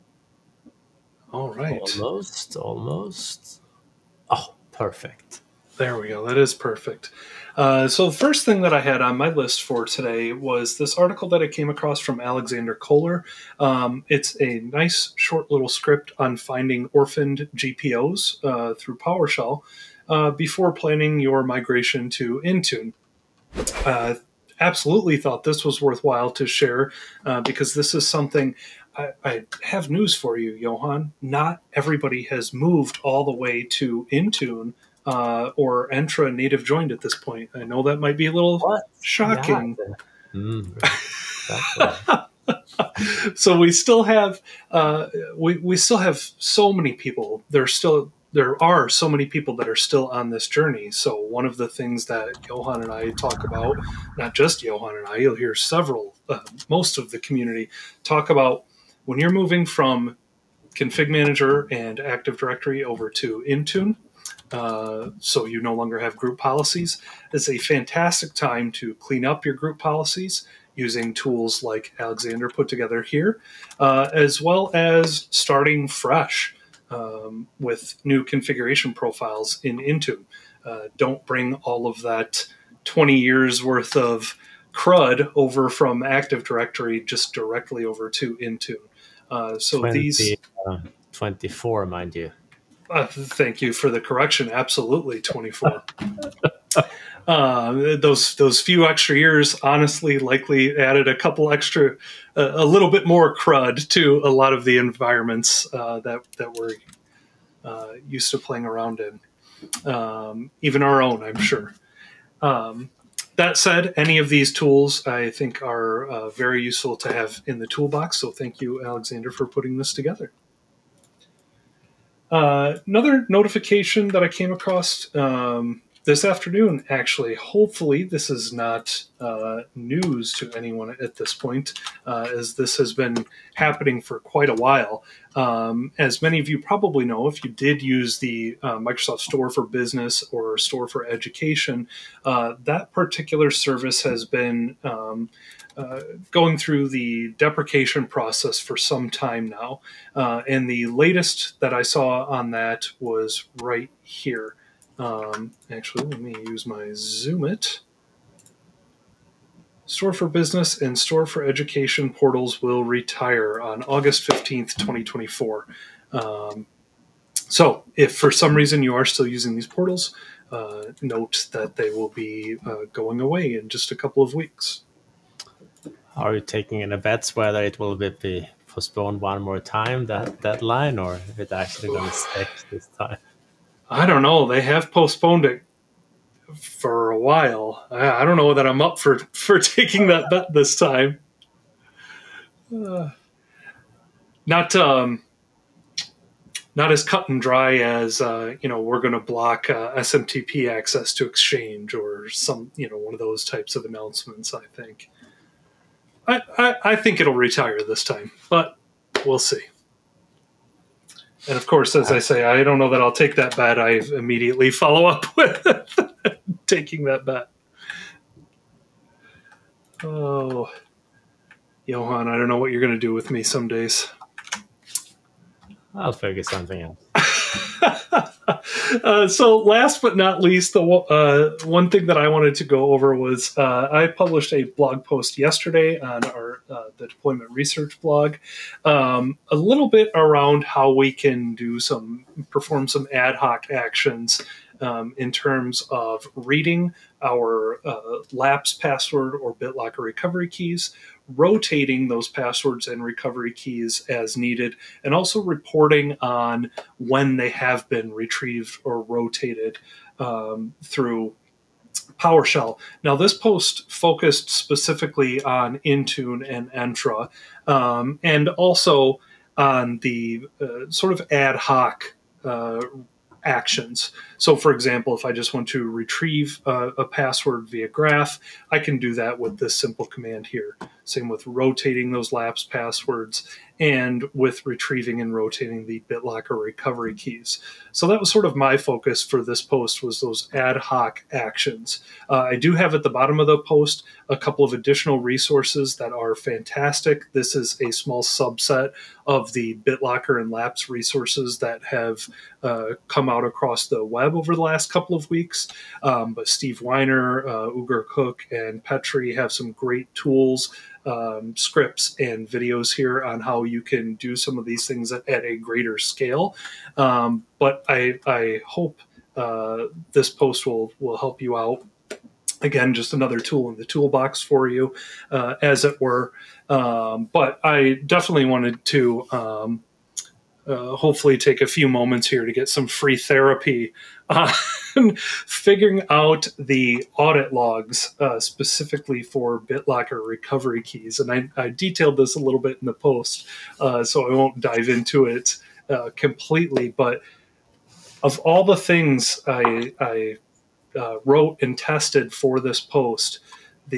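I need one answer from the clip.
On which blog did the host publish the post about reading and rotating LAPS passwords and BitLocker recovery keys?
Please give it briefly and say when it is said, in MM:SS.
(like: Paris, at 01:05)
the deployment research blog, at 03:56.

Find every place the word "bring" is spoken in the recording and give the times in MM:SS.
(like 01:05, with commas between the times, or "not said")
01:21.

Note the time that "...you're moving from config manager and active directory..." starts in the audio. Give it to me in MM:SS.
00:59.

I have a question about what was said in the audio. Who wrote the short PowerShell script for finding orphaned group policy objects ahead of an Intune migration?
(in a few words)
Alexander Koehler.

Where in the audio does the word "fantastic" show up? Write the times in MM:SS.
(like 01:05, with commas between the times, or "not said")
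01:07, 04:56.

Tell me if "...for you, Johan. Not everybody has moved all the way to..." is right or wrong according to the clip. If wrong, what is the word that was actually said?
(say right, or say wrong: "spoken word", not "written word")
right.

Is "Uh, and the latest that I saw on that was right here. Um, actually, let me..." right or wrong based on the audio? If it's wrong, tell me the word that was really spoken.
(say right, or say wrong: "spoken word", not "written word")
right.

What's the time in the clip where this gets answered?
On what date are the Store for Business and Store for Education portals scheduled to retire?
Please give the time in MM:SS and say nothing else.
02:43.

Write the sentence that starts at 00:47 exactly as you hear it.
There still there are so many people that are still on this journey.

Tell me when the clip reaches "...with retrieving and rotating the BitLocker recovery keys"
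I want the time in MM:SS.
04:44.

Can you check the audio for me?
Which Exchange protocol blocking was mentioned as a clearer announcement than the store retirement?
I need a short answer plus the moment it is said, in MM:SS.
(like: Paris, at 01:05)
SMTP, at 03:19.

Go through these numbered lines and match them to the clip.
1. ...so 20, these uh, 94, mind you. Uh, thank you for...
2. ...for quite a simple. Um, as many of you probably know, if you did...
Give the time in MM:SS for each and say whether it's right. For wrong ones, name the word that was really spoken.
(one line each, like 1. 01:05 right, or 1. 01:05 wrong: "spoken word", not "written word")
1. 01:29 wrong: "24", not "94"
2. 02:14 wrong: "while", not "simple".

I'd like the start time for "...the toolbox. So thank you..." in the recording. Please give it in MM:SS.
01:57.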